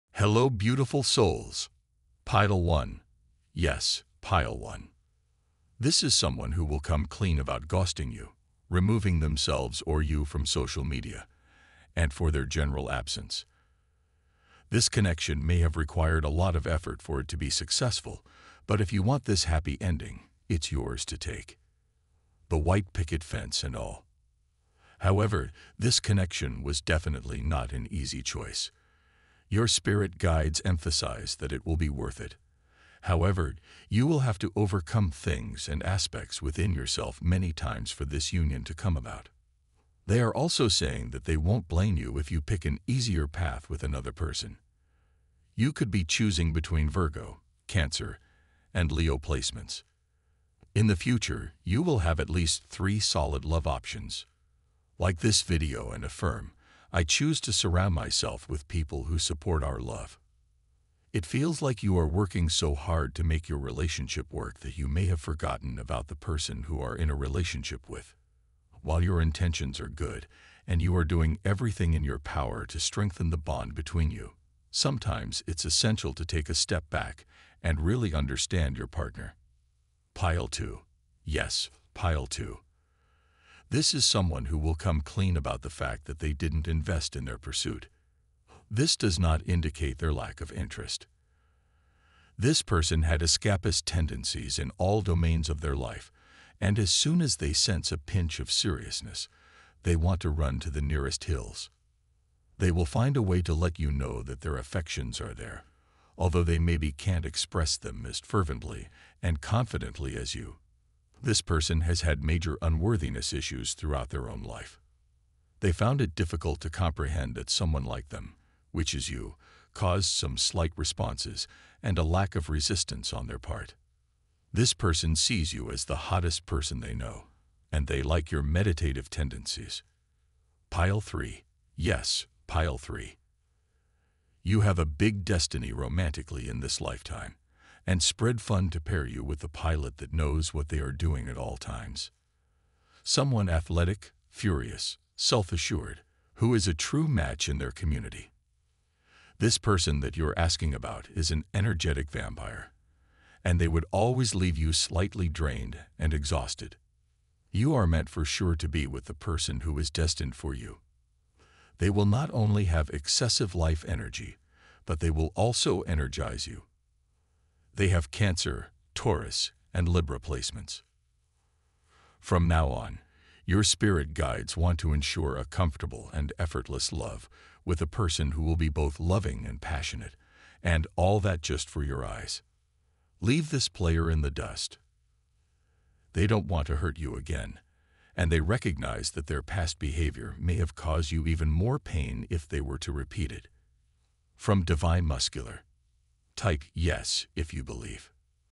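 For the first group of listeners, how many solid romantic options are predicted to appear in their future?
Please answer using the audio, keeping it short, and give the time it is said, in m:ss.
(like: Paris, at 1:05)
3, at 0:52.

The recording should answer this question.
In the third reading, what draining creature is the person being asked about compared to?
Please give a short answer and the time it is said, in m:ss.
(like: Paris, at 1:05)
energetic vampire, at 2:31.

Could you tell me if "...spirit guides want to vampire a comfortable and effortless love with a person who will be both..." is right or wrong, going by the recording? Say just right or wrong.
wrong.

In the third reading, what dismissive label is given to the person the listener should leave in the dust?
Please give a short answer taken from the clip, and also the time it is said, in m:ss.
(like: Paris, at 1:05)
player, at 3:03.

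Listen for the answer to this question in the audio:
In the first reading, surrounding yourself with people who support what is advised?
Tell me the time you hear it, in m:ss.
0:59.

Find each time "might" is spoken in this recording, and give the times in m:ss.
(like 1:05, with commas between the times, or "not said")
not said.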